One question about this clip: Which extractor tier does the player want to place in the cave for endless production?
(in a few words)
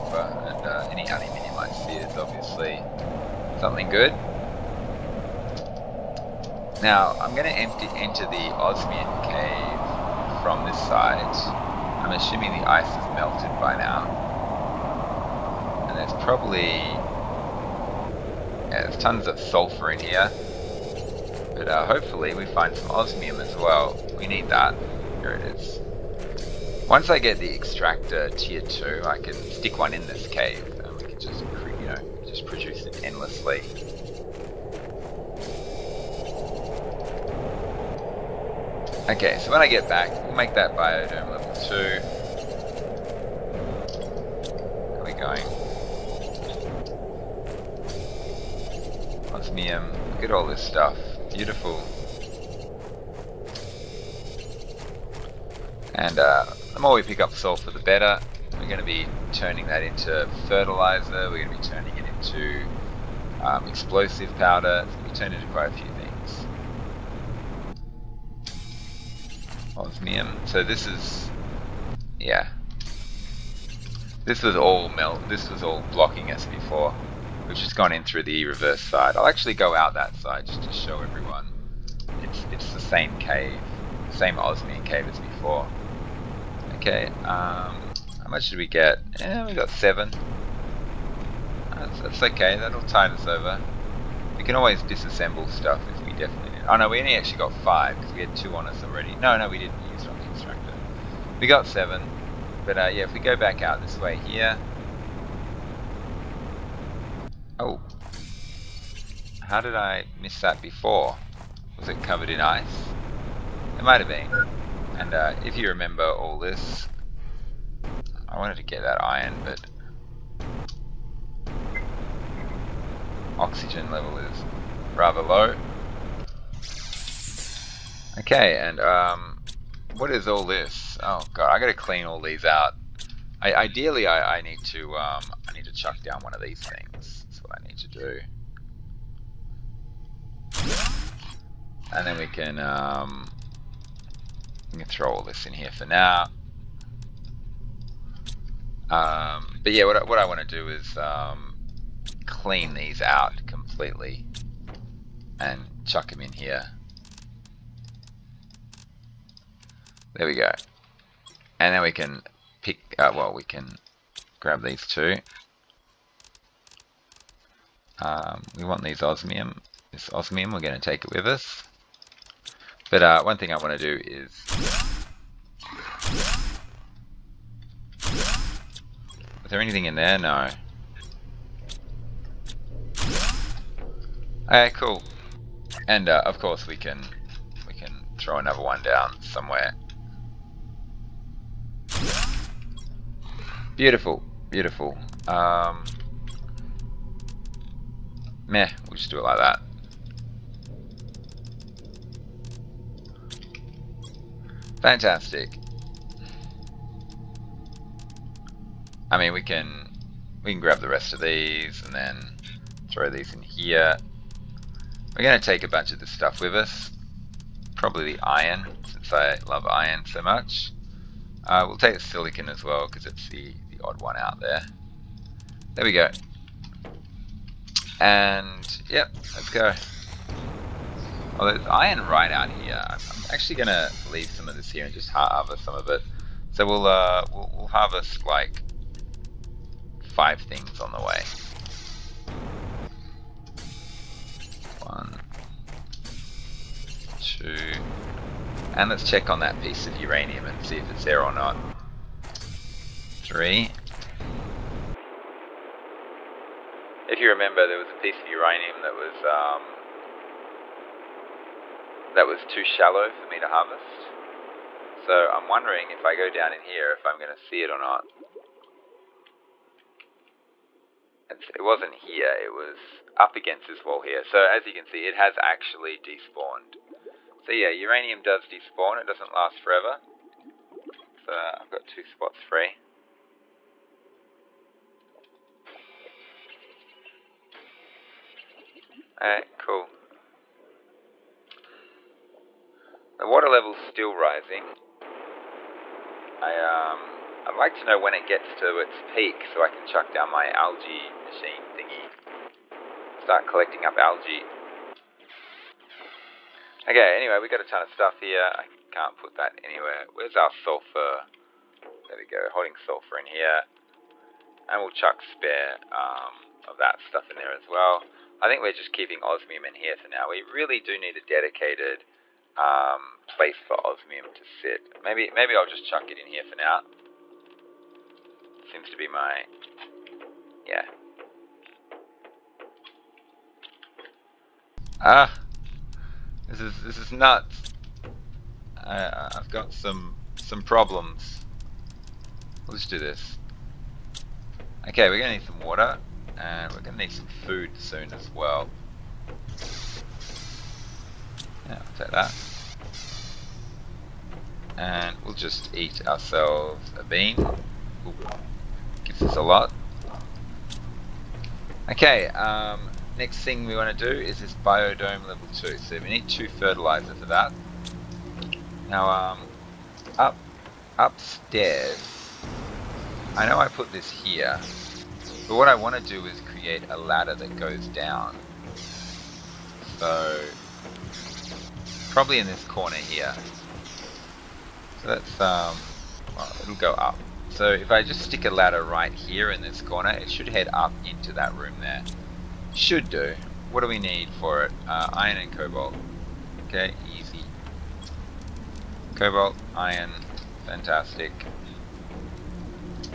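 tier 2.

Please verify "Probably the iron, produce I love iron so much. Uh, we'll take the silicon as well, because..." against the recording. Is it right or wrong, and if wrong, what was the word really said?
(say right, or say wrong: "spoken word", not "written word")
wrong: "since", not "produce".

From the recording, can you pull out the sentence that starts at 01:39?
No, no, we didn't use on the constructor.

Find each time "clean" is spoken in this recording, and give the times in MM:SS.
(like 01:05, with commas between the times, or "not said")
02:11, 02:32.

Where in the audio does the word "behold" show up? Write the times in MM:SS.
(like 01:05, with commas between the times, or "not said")
not said.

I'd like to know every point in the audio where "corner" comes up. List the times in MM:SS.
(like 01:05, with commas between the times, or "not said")
06:22, 06:29.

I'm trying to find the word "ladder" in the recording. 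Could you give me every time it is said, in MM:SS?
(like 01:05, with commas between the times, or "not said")
06:16, 06:28.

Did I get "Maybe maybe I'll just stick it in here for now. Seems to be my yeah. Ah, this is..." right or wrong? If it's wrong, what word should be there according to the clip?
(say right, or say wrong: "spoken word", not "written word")
wrong: "chuck", not "stick".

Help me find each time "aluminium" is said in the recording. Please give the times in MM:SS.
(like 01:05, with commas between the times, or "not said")
00:01.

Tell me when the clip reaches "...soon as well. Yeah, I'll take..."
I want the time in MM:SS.
05:47.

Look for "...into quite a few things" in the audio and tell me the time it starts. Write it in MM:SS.
01:05.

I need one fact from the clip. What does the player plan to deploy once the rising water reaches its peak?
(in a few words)
algae machine.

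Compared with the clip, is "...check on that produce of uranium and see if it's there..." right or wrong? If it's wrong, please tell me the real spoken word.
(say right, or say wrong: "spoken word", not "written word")
wrong: "piece", not "produce".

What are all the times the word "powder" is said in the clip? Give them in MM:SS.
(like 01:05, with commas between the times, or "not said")
01:04.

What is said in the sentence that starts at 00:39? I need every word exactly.
Okay, so when I get back, we'll make that biodome level 2.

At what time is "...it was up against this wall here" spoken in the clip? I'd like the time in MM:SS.
04:32.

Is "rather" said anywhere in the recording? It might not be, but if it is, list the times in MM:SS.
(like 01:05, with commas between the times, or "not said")
02:04.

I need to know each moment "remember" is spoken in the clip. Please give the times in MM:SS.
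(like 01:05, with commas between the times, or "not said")
01:55, 04:17.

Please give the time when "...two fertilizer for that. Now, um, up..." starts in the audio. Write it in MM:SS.
06:06.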